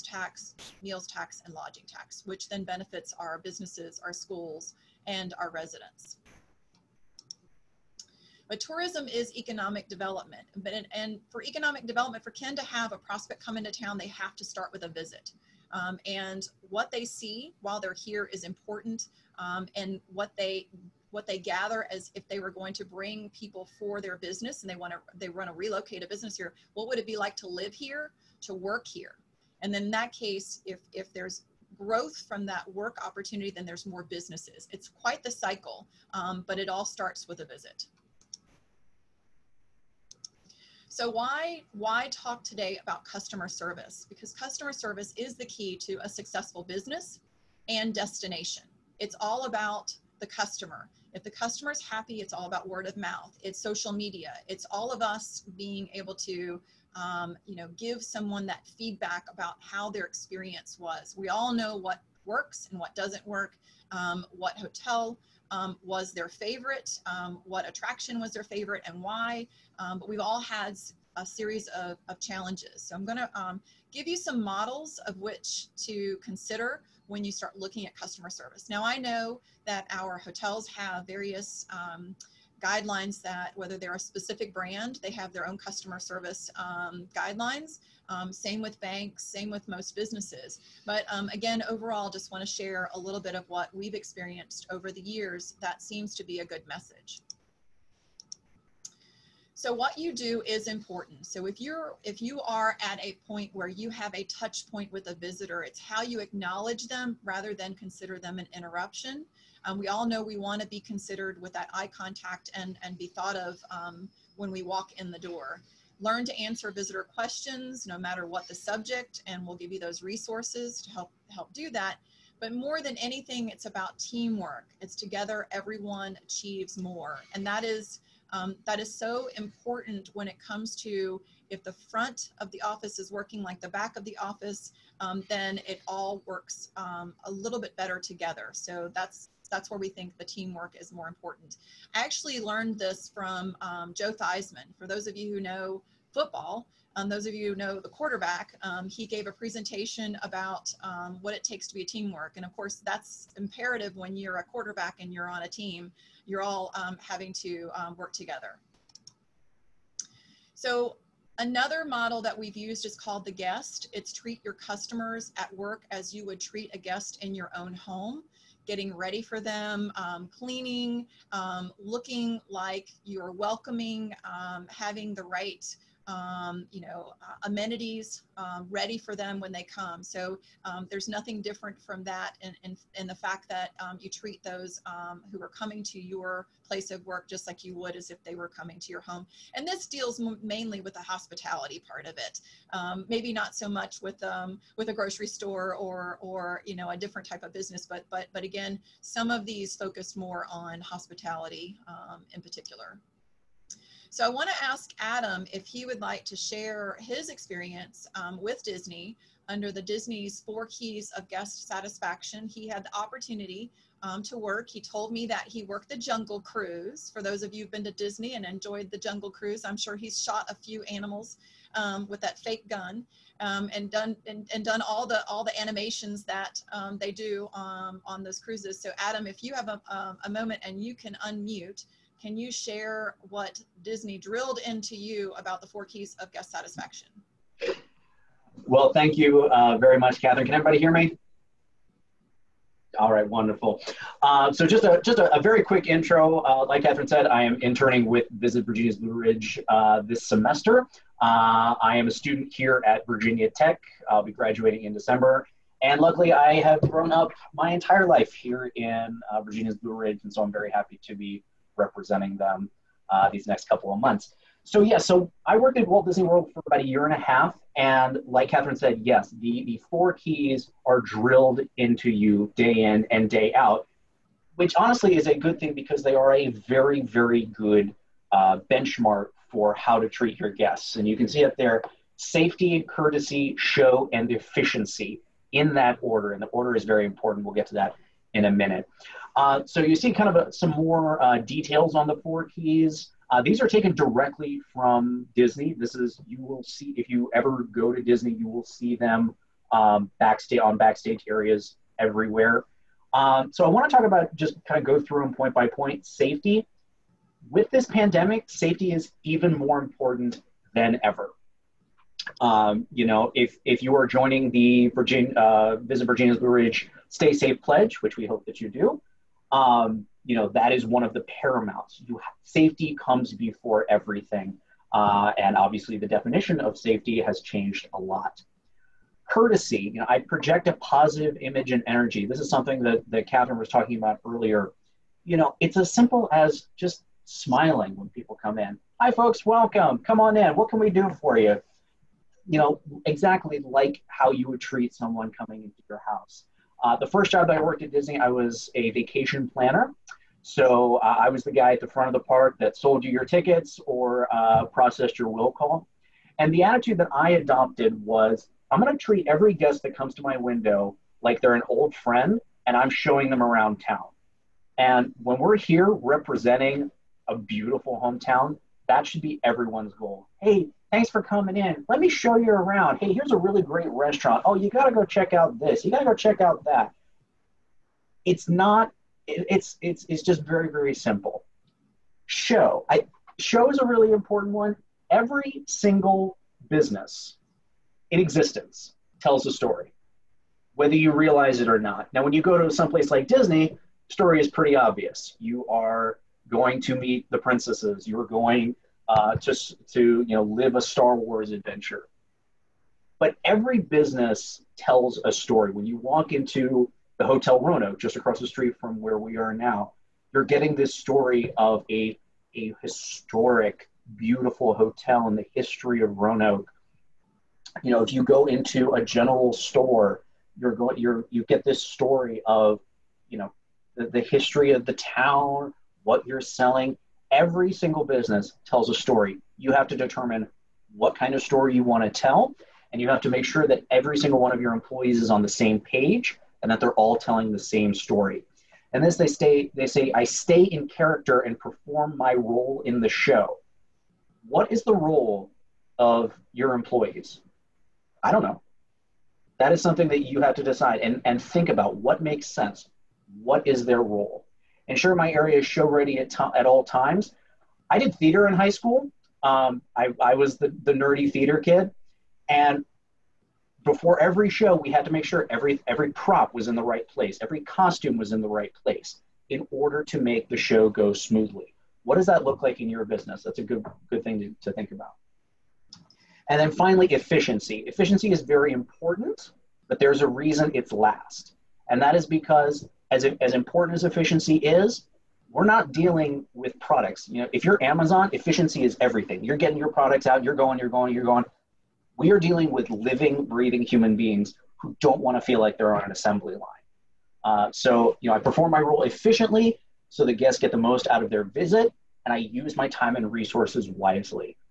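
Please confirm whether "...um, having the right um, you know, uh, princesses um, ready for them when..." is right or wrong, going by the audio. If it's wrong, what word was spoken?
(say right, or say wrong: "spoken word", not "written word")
wrong: "amenities", not "princesses".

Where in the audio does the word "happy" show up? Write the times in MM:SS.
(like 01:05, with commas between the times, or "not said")
00:51, 04:20.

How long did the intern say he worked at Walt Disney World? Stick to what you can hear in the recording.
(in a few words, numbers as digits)
a year and a half.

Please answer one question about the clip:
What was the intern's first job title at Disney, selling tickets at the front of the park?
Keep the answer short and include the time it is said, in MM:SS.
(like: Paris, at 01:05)
vacation planner, at 05:48.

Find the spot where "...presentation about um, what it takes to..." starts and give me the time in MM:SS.
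02:29.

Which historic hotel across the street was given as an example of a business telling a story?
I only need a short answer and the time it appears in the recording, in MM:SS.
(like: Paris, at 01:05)
Hotel Roanoke, at 06:47.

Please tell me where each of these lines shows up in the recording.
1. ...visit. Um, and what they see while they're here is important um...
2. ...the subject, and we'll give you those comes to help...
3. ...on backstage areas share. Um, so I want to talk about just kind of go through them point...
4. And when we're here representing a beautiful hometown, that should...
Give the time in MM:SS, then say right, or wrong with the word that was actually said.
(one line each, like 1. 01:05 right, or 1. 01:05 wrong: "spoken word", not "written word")
1. 00:14 right
2. 01:58 wrong: "resources", not "comes"
3. 05:00 wrong: "everywhere", not "share"
4. 06:04 right.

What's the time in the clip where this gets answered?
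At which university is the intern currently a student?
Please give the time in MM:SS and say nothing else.
04:13.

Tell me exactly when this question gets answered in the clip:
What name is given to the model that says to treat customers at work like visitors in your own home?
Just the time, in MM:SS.
02:43.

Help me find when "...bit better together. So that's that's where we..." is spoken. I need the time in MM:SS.
02:17.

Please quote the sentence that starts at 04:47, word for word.
We'll get to that in a minute.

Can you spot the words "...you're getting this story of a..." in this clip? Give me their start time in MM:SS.
06:50.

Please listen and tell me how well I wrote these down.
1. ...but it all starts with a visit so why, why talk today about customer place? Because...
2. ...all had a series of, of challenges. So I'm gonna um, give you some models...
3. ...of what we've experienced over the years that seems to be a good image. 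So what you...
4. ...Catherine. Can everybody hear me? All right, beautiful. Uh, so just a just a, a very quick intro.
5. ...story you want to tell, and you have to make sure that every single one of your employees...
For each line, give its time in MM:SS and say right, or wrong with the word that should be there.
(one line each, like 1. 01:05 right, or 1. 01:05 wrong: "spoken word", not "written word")
1. 00:36 wrong: "service", not "place"
2. 01:10 right
3. 01:33 wrong: "message", not "image"
4. 04:00 wrong: "wonderful", not "beautiful"
5. 07:11 right.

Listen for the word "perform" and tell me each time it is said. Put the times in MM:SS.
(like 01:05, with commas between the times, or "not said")
07:21, 08:18.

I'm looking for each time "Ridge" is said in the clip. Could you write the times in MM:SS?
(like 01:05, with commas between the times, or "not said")
04:09, 04:19, 05:16.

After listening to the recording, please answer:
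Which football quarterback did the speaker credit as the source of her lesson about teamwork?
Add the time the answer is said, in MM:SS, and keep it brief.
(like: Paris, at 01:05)
Joe Theismann, at 02:23.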